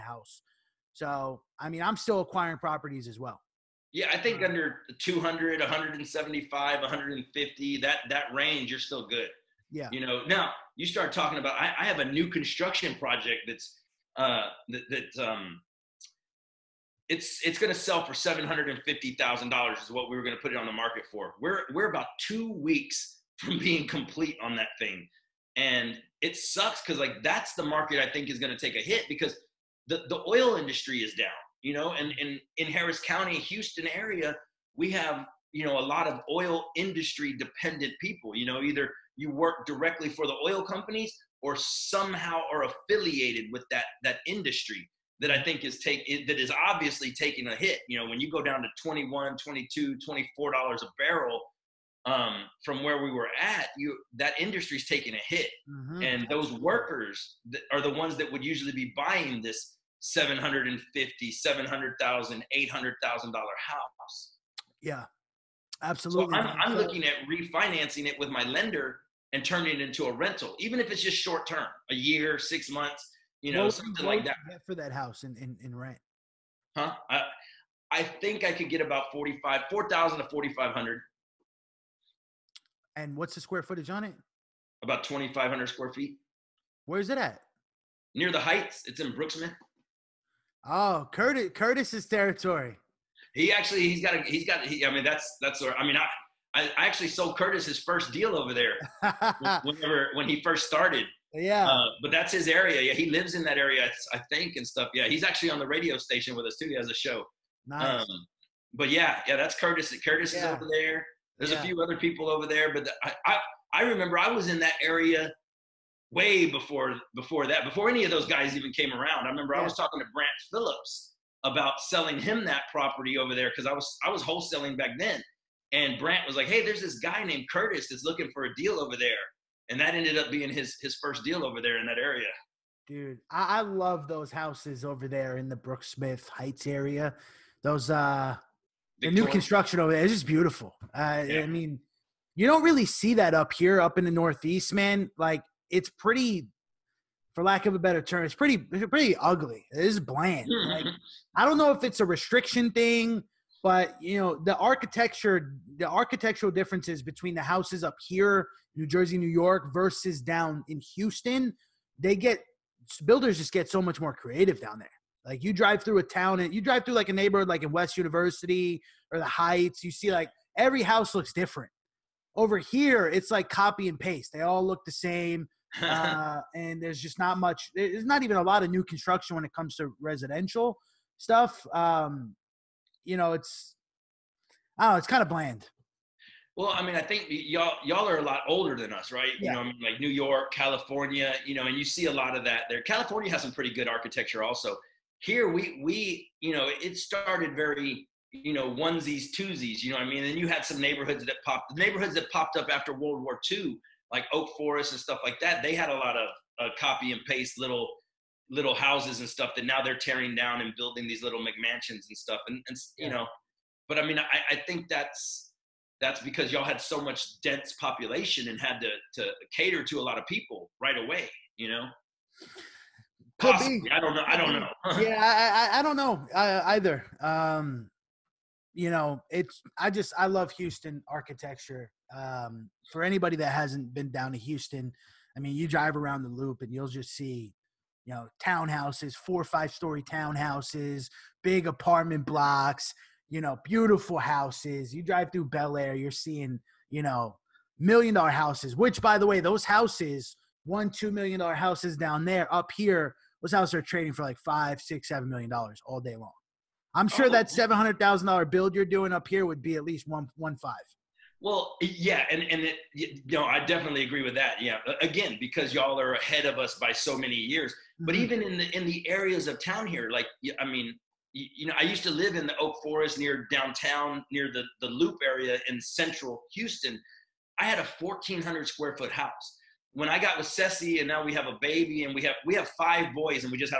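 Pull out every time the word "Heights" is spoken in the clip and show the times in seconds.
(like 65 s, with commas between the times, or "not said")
88 s, 136 s, 169 s.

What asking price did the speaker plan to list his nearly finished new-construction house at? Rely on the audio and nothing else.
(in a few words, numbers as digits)
$750,000.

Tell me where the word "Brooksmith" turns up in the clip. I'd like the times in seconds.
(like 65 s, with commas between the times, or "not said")
89 s, 135 s.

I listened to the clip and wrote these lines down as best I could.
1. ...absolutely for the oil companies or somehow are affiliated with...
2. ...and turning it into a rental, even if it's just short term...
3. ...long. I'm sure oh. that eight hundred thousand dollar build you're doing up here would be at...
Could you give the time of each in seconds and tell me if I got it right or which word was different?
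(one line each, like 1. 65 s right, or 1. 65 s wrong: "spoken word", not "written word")
1. 39 s wrong: "directly", not "absolutely"
2. 69 s right
3. 256 s wrong: "seven", not "eight".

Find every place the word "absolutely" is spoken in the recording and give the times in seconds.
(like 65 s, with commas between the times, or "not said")
65 s.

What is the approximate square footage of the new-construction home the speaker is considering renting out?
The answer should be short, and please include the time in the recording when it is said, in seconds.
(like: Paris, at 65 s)
2,500 square feet, at 84 s.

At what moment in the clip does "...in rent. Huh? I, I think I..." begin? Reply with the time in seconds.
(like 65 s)
75 s.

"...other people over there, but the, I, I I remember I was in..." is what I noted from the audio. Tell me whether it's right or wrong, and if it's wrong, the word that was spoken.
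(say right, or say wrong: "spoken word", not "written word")
right.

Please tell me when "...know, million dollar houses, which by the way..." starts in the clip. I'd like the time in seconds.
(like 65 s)
247 s.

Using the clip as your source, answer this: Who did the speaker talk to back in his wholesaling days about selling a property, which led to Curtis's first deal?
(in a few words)
Brant Phillips.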